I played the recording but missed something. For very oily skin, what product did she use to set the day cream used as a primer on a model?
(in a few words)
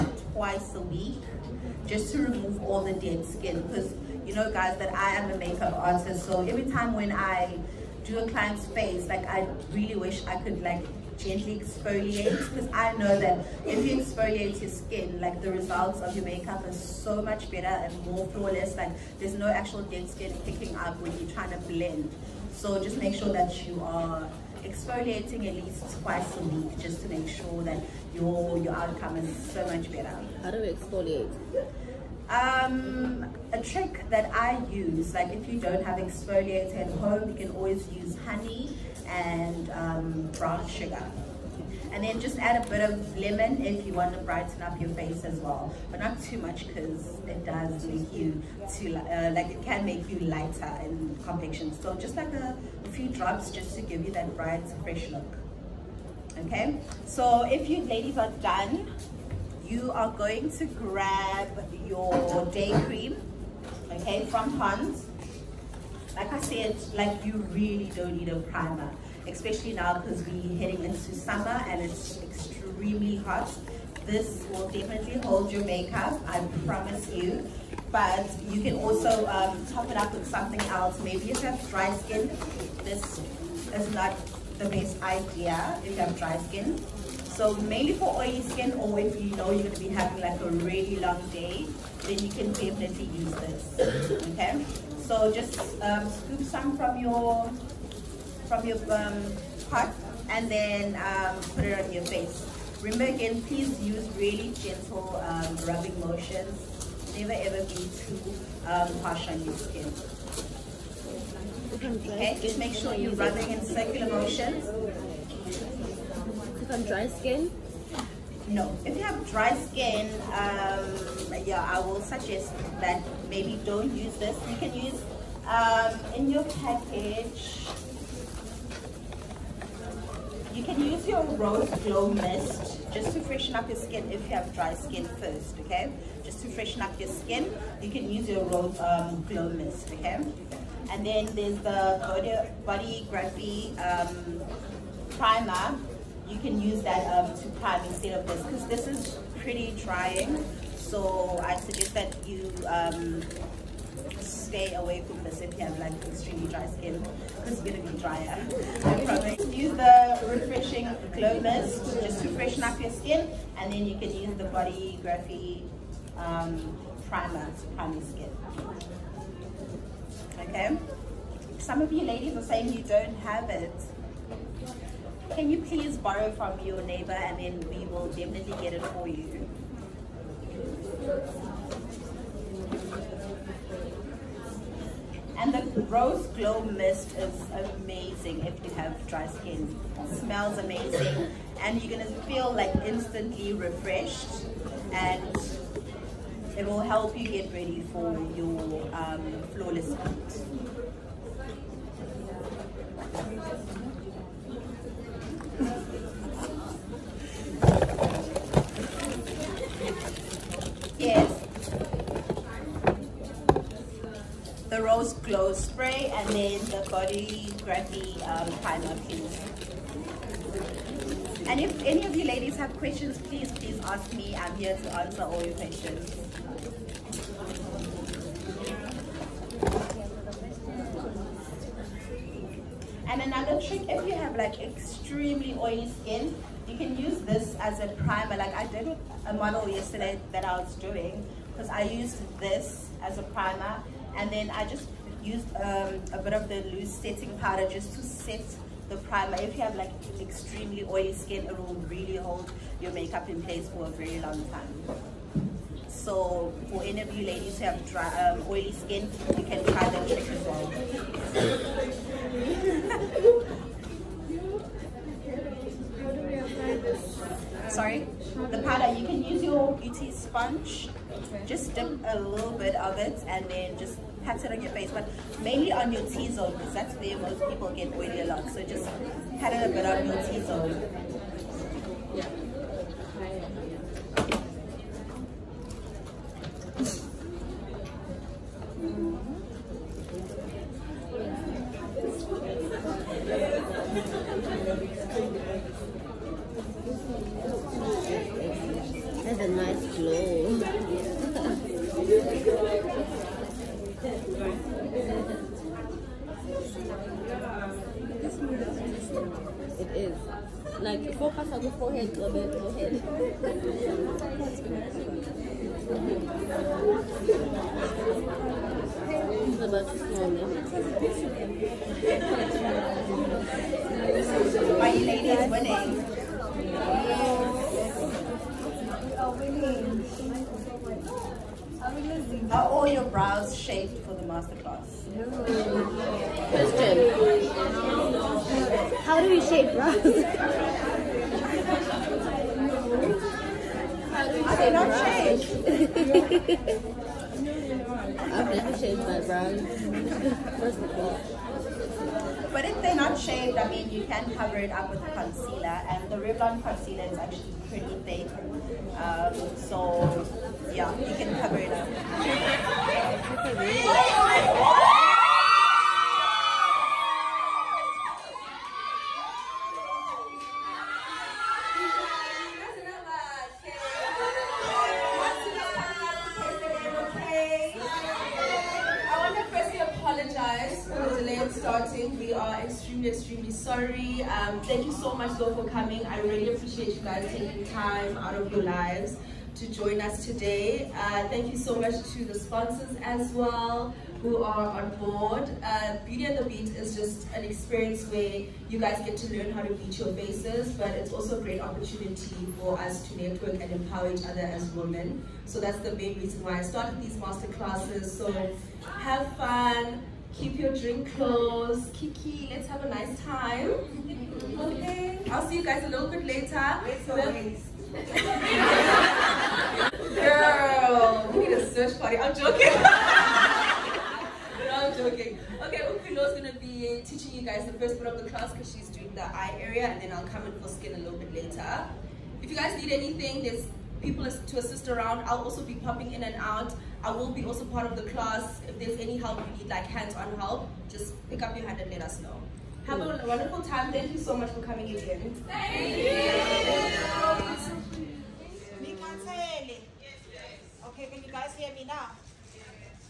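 loose setting powder.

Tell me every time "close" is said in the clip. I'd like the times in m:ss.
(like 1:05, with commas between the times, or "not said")
6:51.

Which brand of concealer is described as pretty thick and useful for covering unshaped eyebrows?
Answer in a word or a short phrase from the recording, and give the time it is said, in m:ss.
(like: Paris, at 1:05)
Revlon, at 5:56.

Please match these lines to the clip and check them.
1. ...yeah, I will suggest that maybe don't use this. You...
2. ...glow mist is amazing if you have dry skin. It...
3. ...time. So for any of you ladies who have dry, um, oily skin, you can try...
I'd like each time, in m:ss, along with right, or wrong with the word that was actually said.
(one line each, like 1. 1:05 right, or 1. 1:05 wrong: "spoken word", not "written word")
1. 2:01 right
2. 3:06 right
3. 4:14 right.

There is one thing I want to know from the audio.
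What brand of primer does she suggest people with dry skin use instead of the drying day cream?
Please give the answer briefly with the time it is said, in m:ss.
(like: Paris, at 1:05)
Bodyography, at 2:44.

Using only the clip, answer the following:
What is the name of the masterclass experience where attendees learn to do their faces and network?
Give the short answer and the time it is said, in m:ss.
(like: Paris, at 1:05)
Beauty and the Beat, at 6:36.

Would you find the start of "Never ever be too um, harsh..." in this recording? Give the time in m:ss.
1:47.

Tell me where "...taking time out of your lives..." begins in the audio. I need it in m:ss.
6:27.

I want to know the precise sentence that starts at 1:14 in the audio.
This will definitely hold your makeup, I promise you.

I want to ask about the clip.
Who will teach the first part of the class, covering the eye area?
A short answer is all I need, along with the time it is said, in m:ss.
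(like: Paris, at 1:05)
Upilo, at 7:05.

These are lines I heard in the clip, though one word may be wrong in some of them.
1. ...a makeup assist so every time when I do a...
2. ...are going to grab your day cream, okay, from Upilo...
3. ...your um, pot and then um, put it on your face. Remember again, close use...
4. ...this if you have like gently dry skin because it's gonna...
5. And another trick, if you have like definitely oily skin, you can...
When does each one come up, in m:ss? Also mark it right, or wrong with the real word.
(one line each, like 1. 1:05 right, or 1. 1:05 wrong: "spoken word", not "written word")
1. 0:05 wrong: "artist", not "assist"
2. 0:59 wrong: "Hans", not "Upilo"
3. 1:38 wrong: "please", not "close"
4. 2:35 wrong: "extremely", not "gently"
5. 3:53 wrong: "extremely", not "definitely".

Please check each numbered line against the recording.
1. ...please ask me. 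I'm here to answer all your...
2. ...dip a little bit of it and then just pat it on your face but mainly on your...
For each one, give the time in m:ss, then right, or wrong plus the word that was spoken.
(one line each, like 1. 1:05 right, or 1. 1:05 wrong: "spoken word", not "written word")
1. 3:43 right
2. 4:31 right.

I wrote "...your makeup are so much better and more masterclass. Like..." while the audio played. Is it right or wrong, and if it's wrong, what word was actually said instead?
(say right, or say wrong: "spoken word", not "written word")
wrong: "flawless", not "masterclass".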